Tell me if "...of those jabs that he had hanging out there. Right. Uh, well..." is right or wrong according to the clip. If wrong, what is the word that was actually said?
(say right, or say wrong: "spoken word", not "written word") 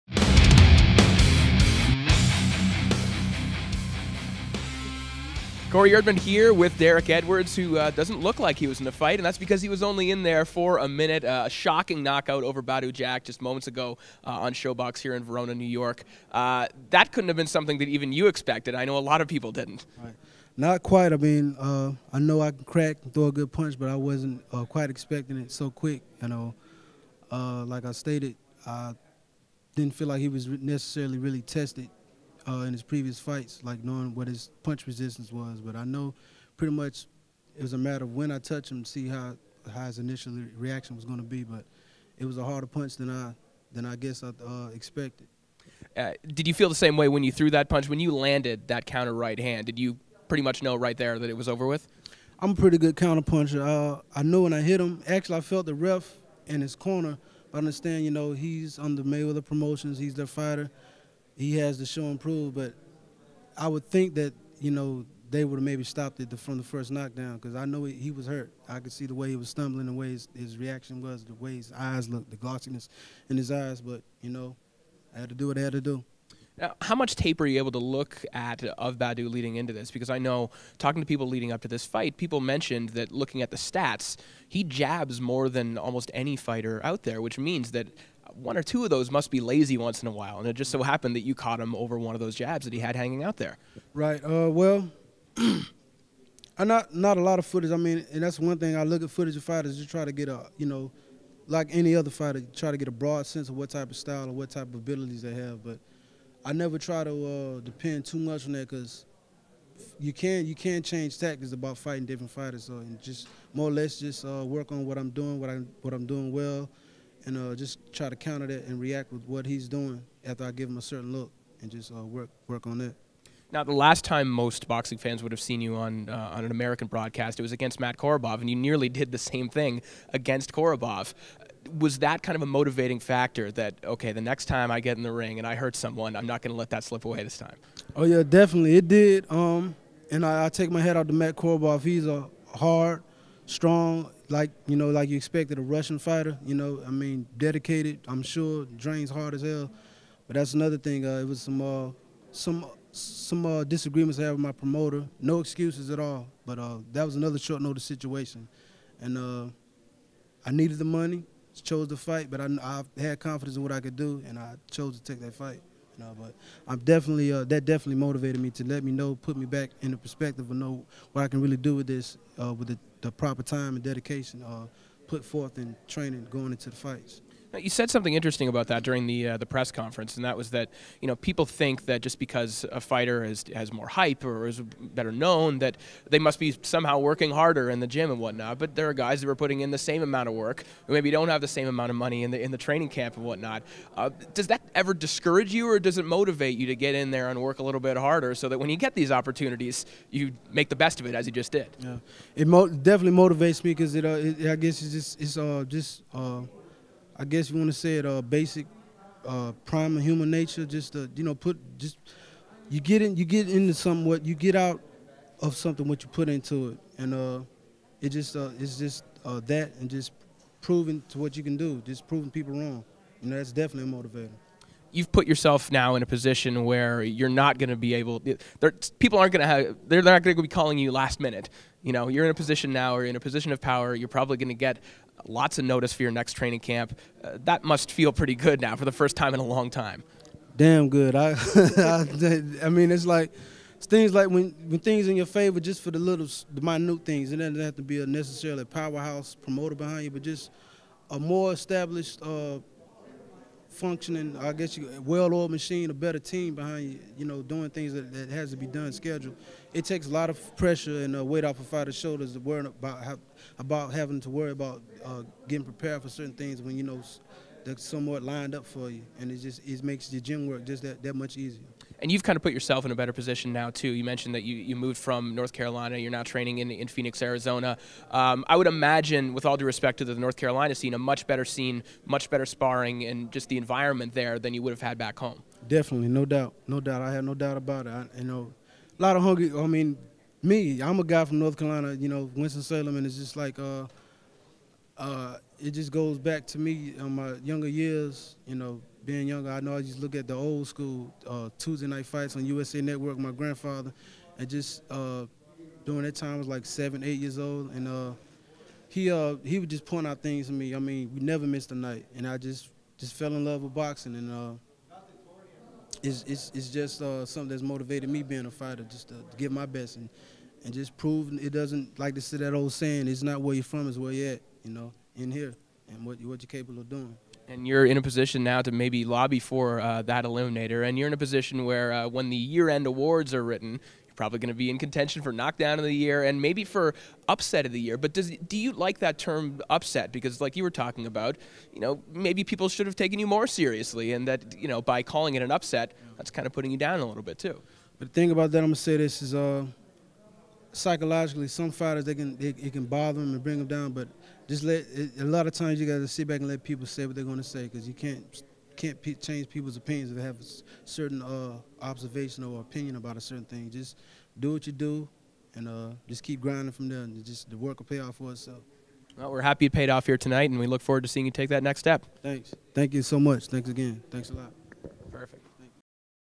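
right.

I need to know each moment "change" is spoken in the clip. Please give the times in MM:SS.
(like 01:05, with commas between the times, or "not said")
01:50, 05:59.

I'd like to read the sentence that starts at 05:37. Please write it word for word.
But does, do you like that term upset?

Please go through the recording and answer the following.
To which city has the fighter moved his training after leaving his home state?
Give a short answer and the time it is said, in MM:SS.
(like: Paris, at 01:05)
Phoenix, Arizona, at 04:36.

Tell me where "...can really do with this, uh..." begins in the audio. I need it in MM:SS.
02:51.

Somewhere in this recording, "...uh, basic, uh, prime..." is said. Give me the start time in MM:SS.
03:28.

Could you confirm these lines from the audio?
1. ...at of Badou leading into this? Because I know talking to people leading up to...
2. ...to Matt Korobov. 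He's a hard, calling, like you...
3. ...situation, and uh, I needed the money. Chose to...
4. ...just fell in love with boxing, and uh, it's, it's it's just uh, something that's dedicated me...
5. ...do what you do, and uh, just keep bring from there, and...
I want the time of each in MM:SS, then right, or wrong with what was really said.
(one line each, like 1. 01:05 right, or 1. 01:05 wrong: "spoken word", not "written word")
1. 01:18 right
2. 02:21 wrong: "strong", not "calling"
3. 02:37 right
4. 05:12 wrong: "motivated", not "dedicated"
5. 06:04 wrong: "grinding", not "bring".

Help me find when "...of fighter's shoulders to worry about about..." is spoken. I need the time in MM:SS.
04:21.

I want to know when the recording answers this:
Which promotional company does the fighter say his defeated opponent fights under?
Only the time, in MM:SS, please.
00:59.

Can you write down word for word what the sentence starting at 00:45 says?
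Uh, did you feel the same way when you threw that punch when you landed that counter right hand?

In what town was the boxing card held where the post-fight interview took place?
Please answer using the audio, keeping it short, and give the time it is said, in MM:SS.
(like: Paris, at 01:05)
Verona, New York, at 00:15.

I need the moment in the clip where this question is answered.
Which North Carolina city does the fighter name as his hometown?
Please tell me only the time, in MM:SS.
04:52.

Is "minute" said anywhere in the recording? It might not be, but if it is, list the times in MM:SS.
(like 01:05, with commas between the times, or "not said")
00:10, 03:51, 04:06.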